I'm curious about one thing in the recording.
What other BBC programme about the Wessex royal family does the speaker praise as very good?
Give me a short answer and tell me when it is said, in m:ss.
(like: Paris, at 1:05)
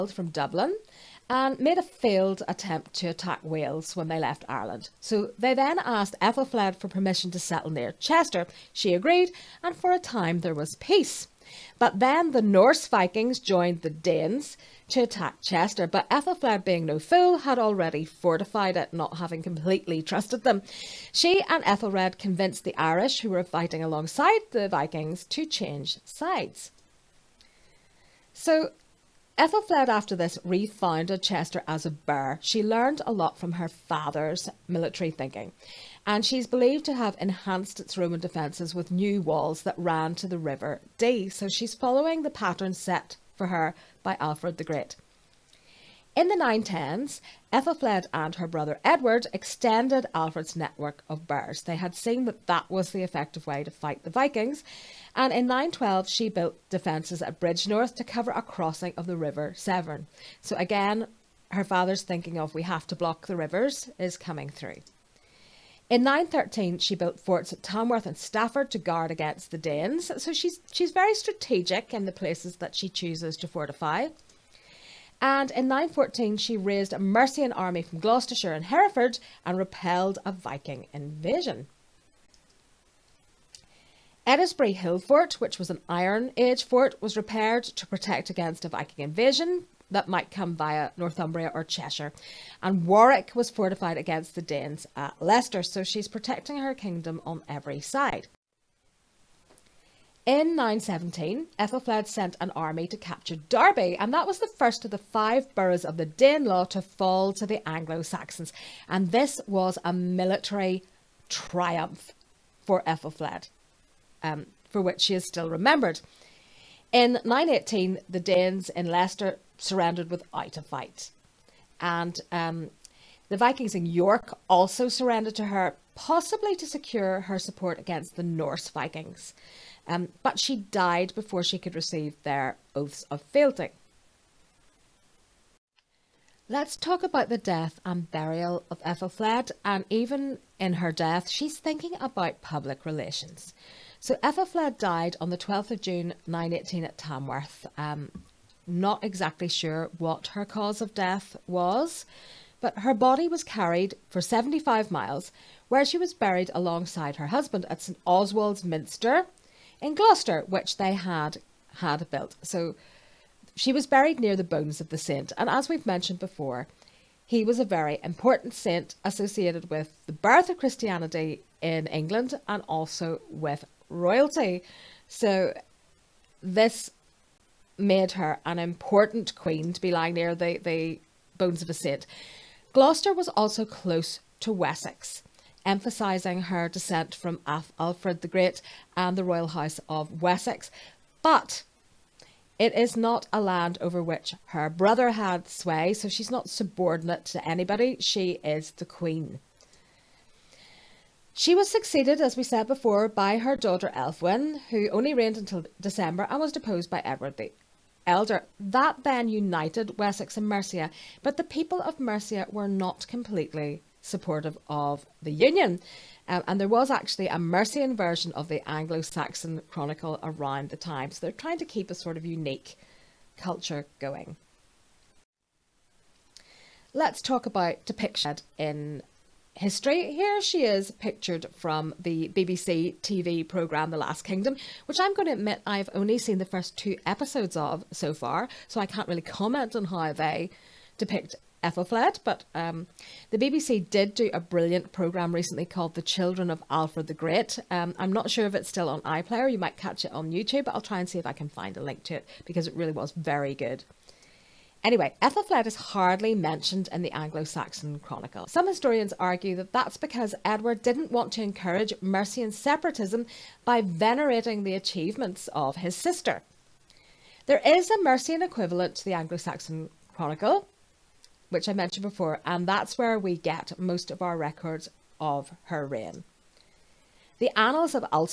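The Children of Alfred the Great, at 4:05.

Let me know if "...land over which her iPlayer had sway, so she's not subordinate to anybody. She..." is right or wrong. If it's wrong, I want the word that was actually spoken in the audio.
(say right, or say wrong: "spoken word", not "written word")
wrong: "brother", not "iPlayer".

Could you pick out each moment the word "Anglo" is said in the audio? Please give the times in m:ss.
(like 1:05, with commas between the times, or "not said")
1:47, 3:38, 4:17, 4:29.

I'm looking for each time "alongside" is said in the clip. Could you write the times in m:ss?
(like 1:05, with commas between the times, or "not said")
0:23, 2:36.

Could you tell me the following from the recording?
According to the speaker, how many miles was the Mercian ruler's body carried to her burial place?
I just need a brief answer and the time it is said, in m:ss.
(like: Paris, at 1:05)
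75, at 2:34.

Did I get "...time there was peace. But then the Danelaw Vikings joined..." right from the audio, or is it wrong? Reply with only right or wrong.
wrong.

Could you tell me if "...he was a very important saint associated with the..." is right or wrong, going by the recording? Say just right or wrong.
right.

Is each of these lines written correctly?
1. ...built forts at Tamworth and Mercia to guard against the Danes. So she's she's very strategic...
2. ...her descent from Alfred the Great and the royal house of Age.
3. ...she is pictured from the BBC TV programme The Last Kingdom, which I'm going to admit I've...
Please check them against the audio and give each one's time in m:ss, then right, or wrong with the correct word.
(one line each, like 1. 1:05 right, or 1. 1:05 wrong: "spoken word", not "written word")
1. 1:06 wrong: "Stafford", not "Mercia"
2. 3:06 wrong: "Wessex", not "Age"
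3. 3:50 right.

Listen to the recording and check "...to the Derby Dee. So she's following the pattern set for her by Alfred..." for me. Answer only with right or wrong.
wrong.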